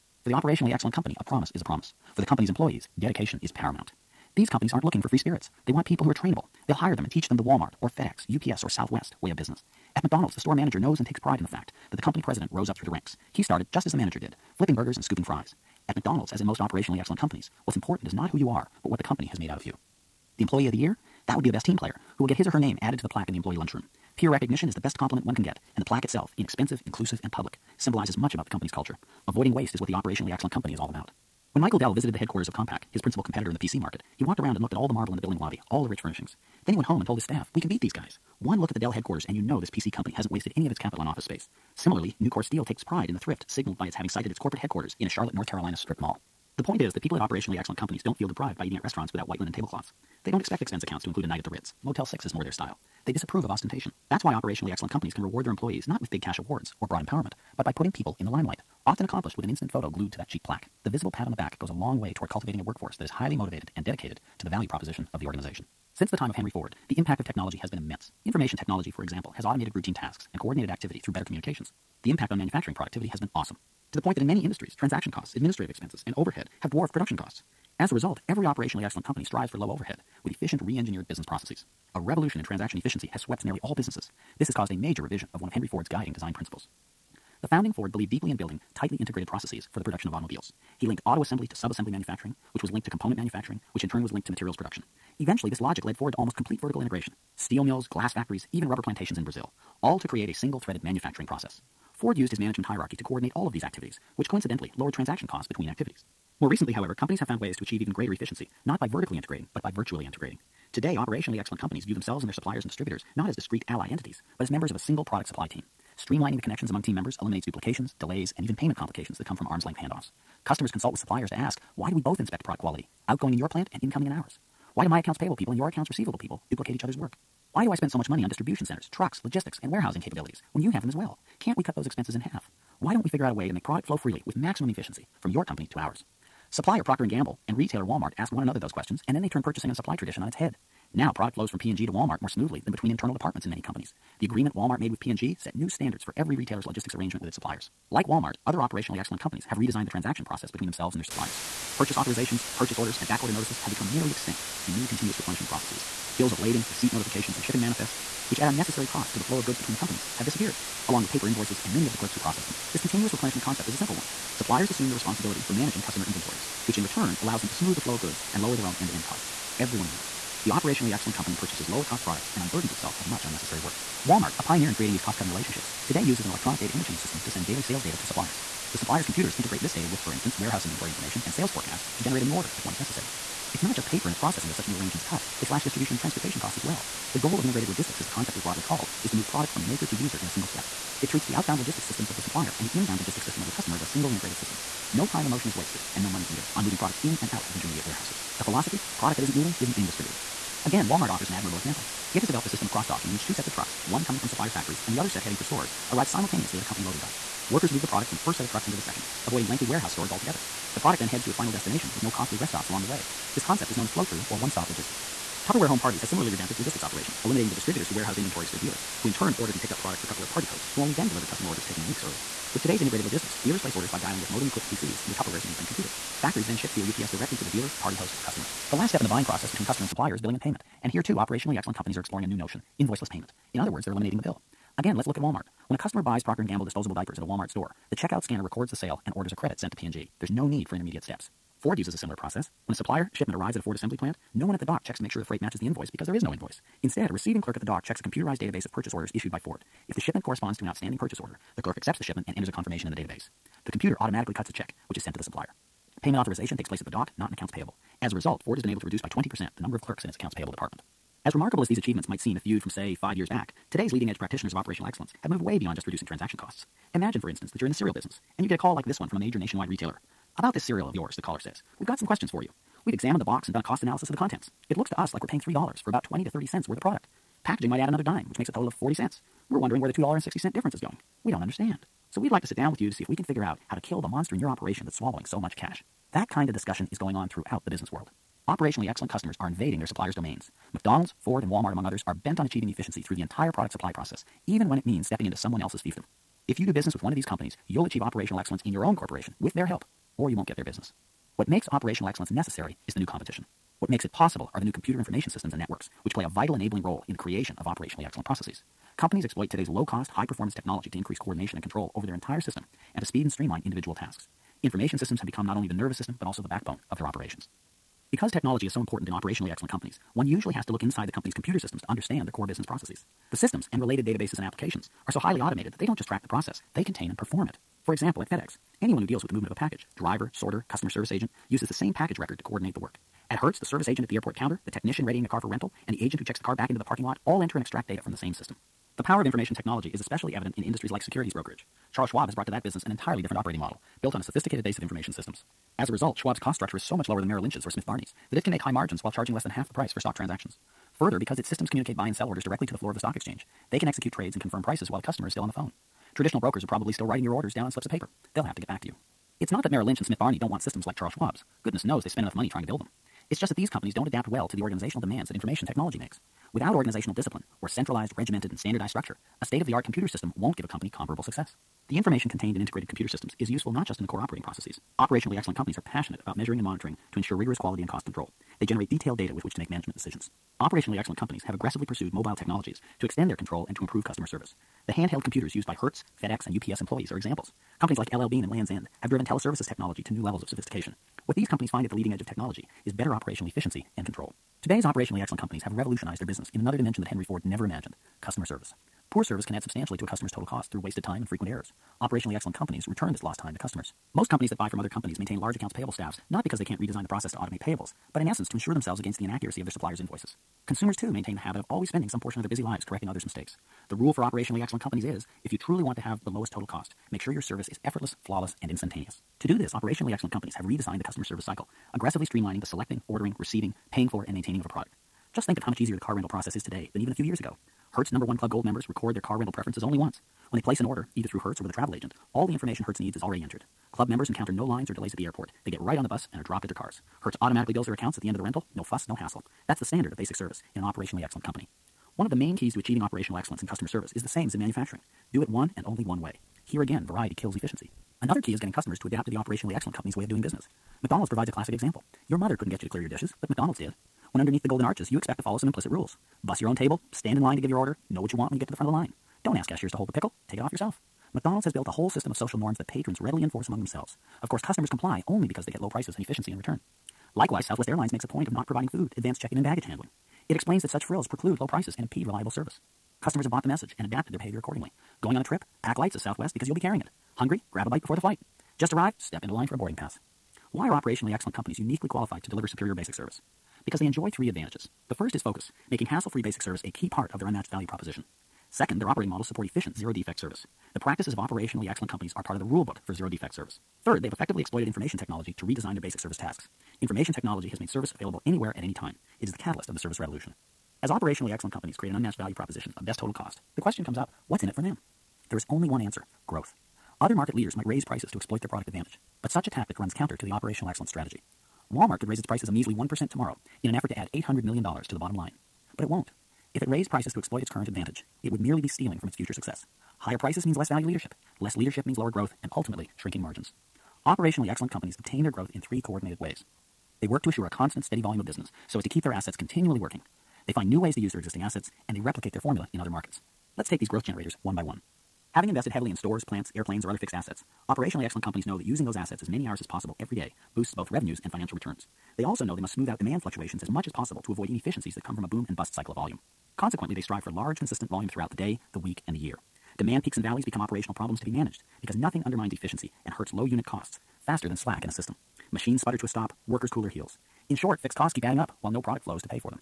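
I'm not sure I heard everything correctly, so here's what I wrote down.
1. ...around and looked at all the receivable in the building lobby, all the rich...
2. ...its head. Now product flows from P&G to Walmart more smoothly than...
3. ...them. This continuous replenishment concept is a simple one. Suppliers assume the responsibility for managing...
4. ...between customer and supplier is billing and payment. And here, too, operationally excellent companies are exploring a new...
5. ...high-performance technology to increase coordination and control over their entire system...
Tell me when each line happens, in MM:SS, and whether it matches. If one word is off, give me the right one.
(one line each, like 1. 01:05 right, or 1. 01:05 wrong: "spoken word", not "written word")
1. 00:34 wrong: "marble", not "receivable"
2. 02:20 right
3. 02:42 right
4. 03:49 right
5. 05:10 right.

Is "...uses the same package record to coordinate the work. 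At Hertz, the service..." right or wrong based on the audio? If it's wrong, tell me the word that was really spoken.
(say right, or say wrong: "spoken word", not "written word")
right.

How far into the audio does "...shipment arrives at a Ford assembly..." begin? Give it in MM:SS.
04:03.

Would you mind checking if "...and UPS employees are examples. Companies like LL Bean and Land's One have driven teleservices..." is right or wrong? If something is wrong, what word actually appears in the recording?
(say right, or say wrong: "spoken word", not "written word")
wrong: "End", not "One".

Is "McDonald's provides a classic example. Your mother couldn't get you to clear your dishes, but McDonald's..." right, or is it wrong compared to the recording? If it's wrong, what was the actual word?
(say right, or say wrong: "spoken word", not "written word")
right.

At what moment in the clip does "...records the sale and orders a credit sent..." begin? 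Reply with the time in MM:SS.
03:58.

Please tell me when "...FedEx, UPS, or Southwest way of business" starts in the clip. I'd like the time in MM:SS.
00:07.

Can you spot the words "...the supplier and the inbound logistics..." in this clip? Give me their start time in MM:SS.
03:12.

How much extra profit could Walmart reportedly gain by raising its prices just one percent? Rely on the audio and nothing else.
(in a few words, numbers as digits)
$800 million.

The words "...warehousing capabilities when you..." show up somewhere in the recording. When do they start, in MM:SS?
02:09.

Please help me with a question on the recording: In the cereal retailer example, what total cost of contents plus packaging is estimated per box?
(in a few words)
40 cents.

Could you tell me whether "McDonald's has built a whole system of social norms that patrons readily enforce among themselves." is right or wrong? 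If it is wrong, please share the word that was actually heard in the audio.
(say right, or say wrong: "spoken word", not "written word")
right.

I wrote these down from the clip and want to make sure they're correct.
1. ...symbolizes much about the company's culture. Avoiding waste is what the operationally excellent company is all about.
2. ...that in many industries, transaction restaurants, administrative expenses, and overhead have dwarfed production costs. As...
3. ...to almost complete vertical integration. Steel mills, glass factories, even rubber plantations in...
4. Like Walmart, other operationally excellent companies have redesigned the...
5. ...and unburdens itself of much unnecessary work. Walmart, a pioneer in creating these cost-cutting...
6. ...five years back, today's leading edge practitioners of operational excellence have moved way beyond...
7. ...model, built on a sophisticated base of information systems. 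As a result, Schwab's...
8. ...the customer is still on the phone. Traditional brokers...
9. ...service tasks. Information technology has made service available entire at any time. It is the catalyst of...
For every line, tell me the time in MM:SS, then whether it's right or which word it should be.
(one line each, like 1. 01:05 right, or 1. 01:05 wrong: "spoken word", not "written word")
1. 00:27 right
2. 01:14 wrong: "costs", not "restaurants"
3. 01:36 right
4. 02:27 right
5. 02:52 right
6. 04:22 right
7. 05:43 right
8. 05:54 right
9. 08:16 wrong: "anywhere", not "entire".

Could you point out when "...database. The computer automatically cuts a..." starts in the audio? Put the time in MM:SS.
04:12.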